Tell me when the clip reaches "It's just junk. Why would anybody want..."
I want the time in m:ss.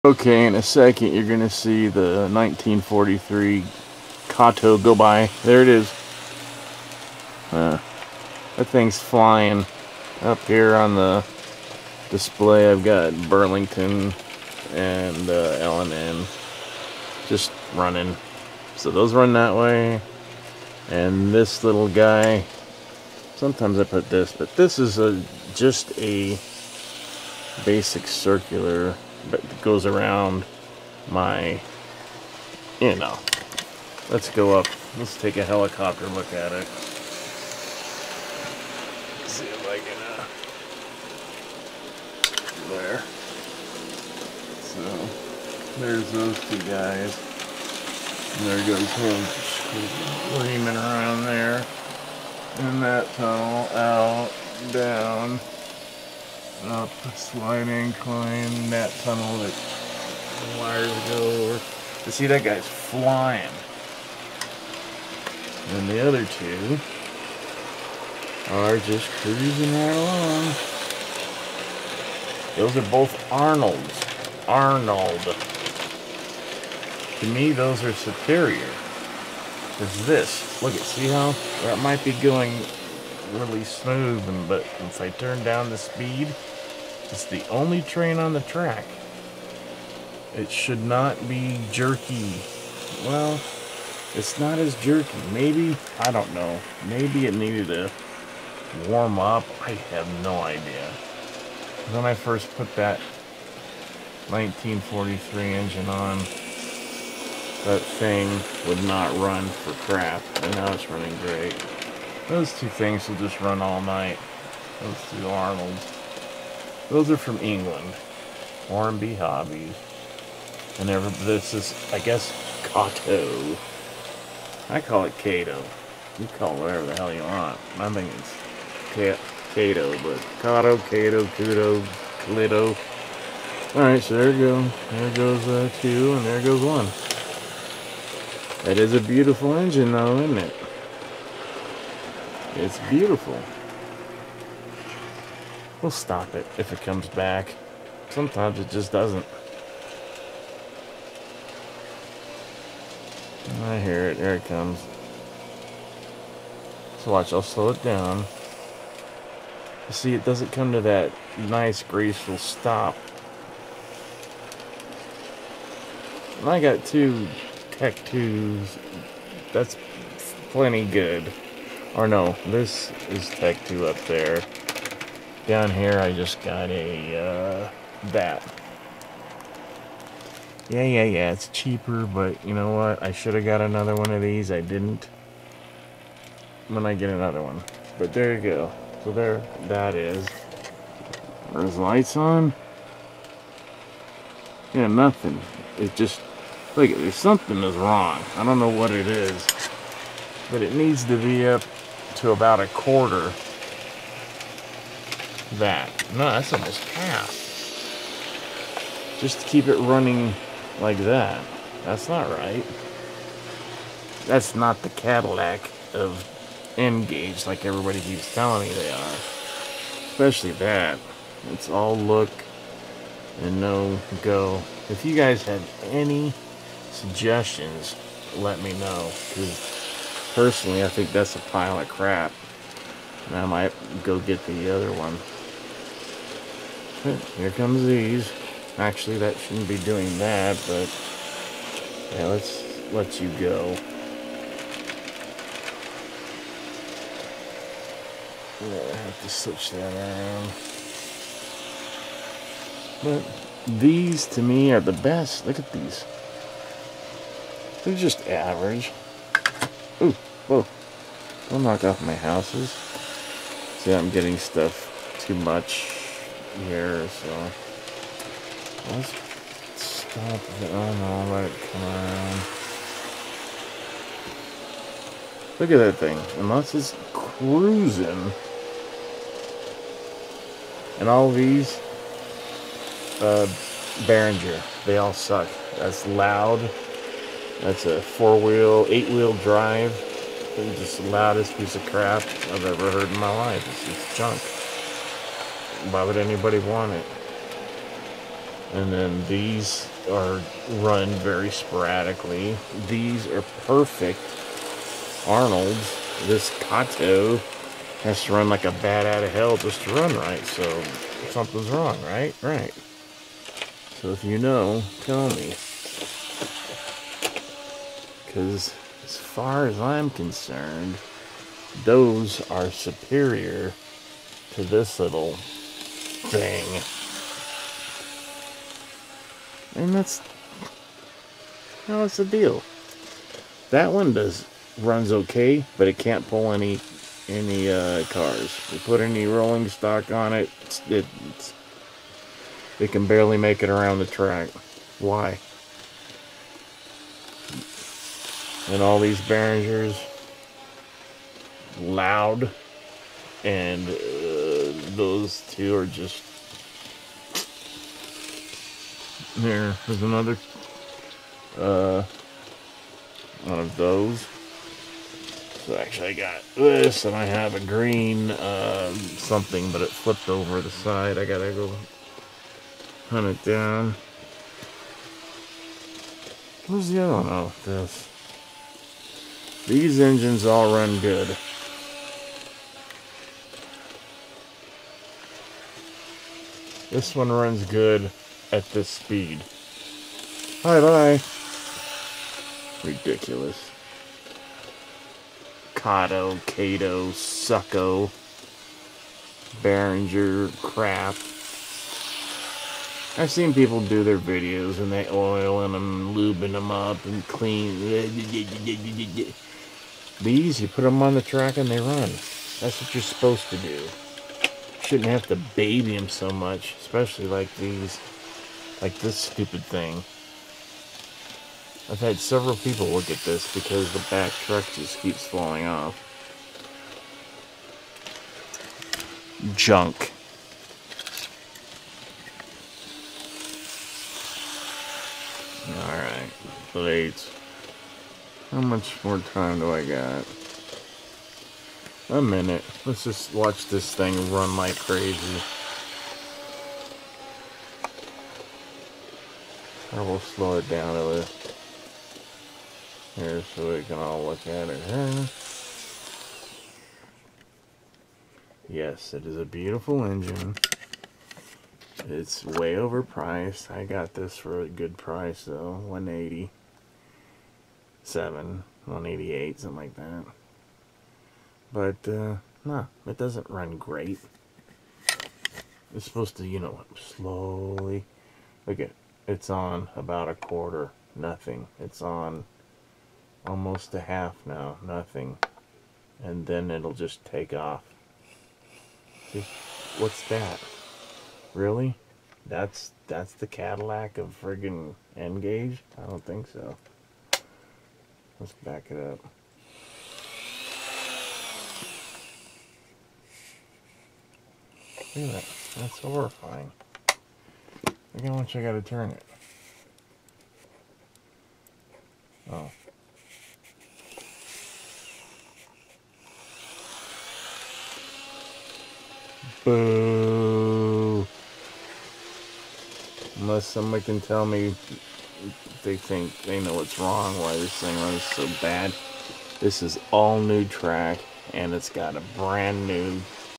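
4:53.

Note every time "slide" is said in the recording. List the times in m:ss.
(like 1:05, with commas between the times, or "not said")
0:57.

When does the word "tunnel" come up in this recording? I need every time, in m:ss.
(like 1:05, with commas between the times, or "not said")
0:53, 0:59.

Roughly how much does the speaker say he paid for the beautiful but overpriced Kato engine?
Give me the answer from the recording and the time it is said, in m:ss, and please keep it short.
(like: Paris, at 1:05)
187, at 7:45.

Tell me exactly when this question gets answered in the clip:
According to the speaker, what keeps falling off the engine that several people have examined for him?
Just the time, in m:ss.
7:04.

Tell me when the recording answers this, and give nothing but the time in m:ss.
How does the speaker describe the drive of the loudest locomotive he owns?
4:48.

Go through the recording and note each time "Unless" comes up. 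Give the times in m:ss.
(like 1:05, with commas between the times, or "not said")
4:36, 8:43.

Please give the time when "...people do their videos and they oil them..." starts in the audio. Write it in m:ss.
6:43.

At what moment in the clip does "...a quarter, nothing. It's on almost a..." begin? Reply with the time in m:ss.
8:00.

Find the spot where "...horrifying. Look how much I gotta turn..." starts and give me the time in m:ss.
8:25.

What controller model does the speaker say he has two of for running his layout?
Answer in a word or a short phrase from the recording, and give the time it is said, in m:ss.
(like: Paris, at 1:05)
Tech 2, at 2:47.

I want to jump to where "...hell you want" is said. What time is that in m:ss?
2:06.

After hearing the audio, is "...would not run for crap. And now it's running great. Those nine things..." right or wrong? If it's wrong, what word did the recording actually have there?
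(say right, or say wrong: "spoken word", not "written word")
wrong: "two", not "nine".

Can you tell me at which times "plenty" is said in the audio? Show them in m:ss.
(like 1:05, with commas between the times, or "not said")
2:50.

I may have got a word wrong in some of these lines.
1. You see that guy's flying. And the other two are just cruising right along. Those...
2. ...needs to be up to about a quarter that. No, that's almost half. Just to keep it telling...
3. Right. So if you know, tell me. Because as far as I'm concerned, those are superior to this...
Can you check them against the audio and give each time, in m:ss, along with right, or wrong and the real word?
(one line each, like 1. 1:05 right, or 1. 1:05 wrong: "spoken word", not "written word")
1. 1:02 right
2. 3:20 wrong: "running", not "telling"
3. 5:12 right.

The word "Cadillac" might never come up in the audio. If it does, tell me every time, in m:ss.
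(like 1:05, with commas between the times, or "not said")
3:34, 8:13.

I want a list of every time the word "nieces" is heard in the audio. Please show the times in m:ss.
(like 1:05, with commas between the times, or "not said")
not said.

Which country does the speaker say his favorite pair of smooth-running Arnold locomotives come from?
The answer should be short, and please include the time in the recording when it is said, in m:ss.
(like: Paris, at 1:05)
England, at 1:57.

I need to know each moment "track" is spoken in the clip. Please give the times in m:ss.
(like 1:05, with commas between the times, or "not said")
1:28, 5:44, 6:51, 8:50.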